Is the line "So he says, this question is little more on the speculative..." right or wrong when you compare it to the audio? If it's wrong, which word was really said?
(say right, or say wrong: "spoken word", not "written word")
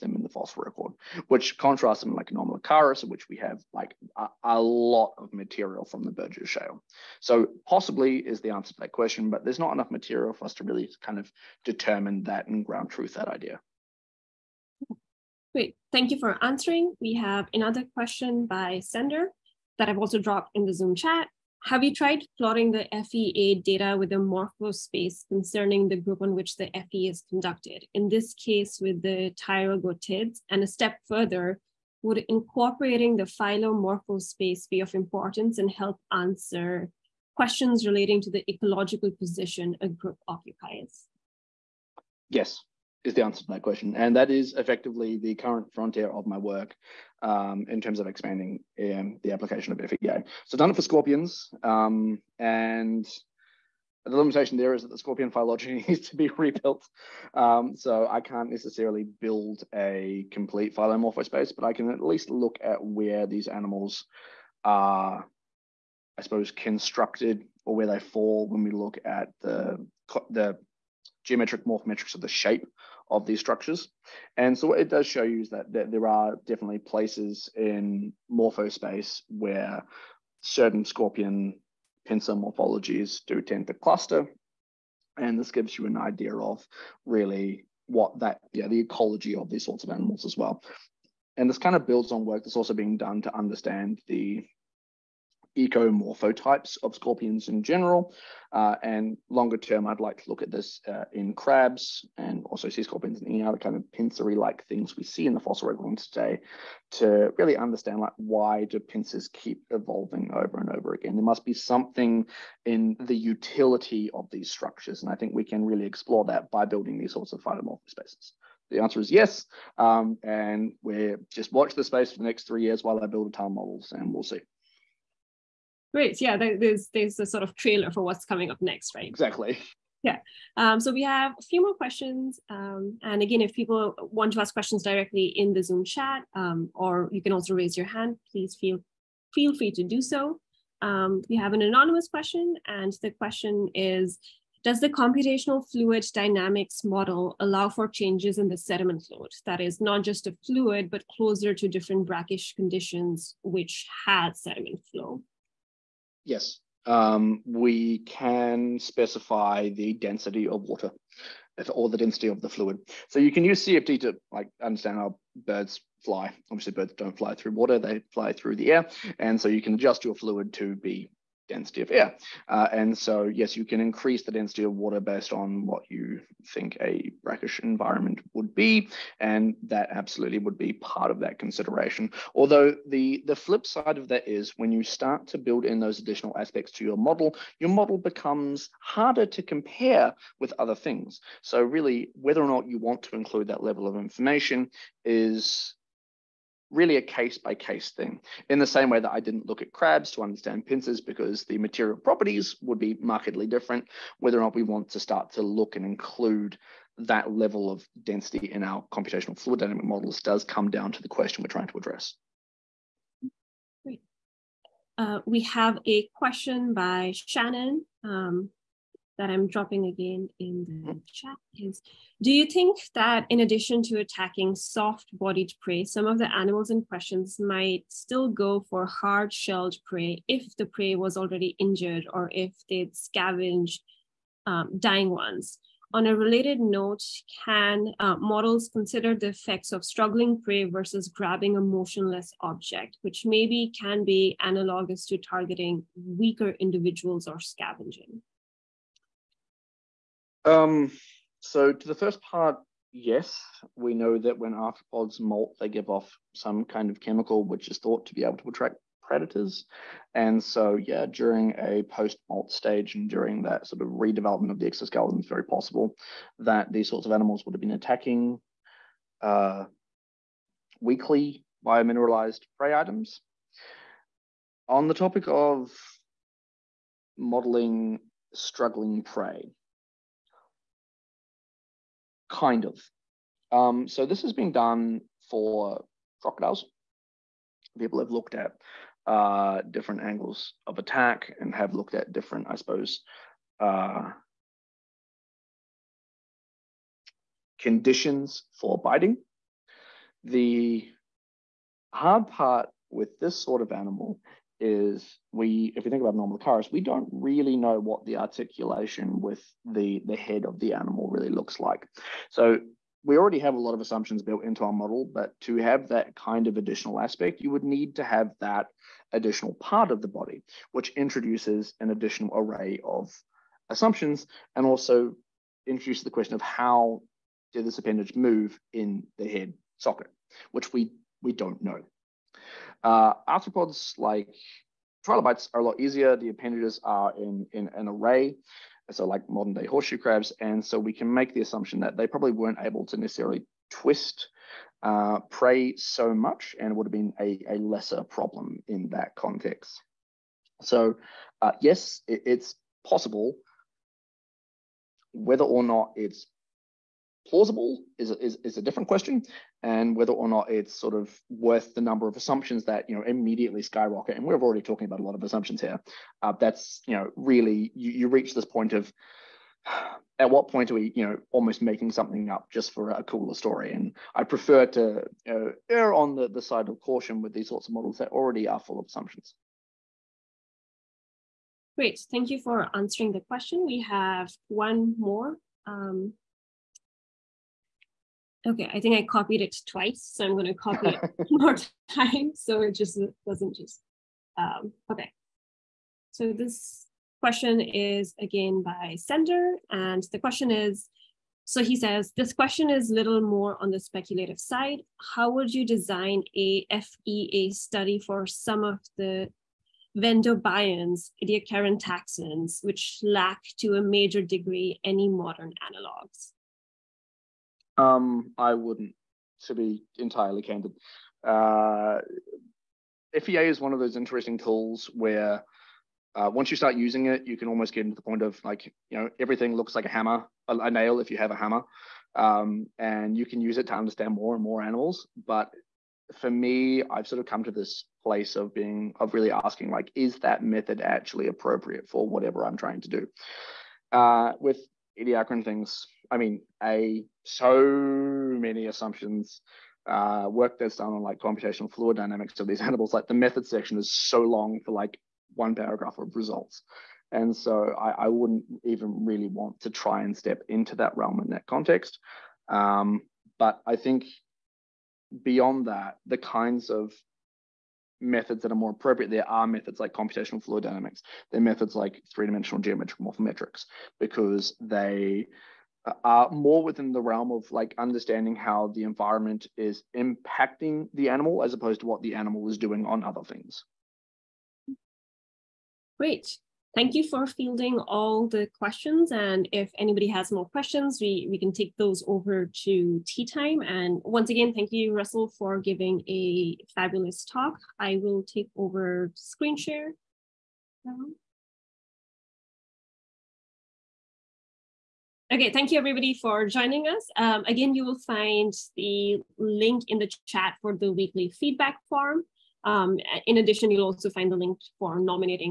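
right.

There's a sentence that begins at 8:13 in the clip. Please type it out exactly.
And once again, thank you, Russell, for giving a fabulous talk.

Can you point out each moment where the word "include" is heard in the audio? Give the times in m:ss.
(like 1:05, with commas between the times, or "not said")
3:13, 3:25.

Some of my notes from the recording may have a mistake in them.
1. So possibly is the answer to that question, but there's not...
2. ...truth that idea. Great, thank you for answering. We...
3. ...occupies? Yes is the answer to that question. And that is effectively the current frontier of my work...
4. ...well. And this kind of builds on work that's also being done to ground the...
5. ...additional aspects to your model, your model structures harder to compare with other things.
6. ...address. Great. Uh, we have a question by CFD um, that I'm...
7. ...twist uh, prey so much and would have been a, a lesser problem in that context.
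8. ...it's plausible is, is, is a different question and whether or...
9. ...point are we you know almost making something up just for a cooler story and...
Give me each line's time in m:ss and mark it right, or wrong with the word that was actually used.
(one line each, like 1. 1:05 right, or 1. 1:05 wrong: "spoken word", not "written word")
1. 0:07 right
2. 0:12 right
3. 0:40 right
4. 1:30 wrong: "understand", not "ground"
5. 3:05 wrong: "becomes", not "structures"
6. 3:31 wrong: "Shannon", not "CFD"
7. 5:43 right
8. 5:55 right
9. 6:10 right.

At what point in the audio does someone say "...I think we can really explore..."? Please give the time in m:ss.
1:55.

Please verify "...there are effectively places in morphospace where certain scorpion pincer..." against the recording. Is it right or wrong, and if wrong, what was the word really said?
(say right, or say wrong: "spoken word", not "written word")
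wrong: "definitely", not "effectively".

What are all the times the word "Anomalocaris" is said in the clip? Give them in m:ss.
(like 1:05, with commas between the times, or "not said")
0:02, 5:06.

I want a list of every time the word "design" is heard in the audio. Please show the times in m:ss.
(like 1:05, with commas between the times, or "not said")
6:45.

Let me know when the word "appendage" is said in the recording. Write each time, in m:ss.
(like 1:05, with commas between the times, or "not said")
5:27, 5:36.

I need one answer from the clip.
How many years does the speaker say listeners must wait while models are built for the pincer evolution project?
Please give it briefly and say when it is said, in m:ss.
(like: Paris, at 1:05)
3, at 2:02.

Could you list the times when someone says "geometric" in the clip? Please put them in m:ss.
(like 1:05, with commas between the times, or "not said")
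1:11, 7:52.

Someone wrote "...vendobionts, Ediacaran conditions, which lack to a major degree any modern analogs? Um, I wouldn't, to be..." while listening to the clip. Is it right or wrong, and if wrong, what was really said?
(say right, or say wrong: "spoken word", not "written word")
wrong: "taxons", not "conditions".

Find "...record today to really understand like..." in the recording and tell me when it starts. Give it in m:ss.
1:45.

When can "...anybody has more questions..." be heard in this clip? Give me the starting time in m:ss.
8:09.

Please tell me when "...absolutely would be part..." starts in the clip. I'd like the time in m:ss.
2:59.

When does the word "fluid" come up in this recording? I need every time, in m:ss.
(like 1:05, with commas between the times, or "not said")
2:25, 2:30, 2:42, 2:50, 3:29, 7:31, 7:50.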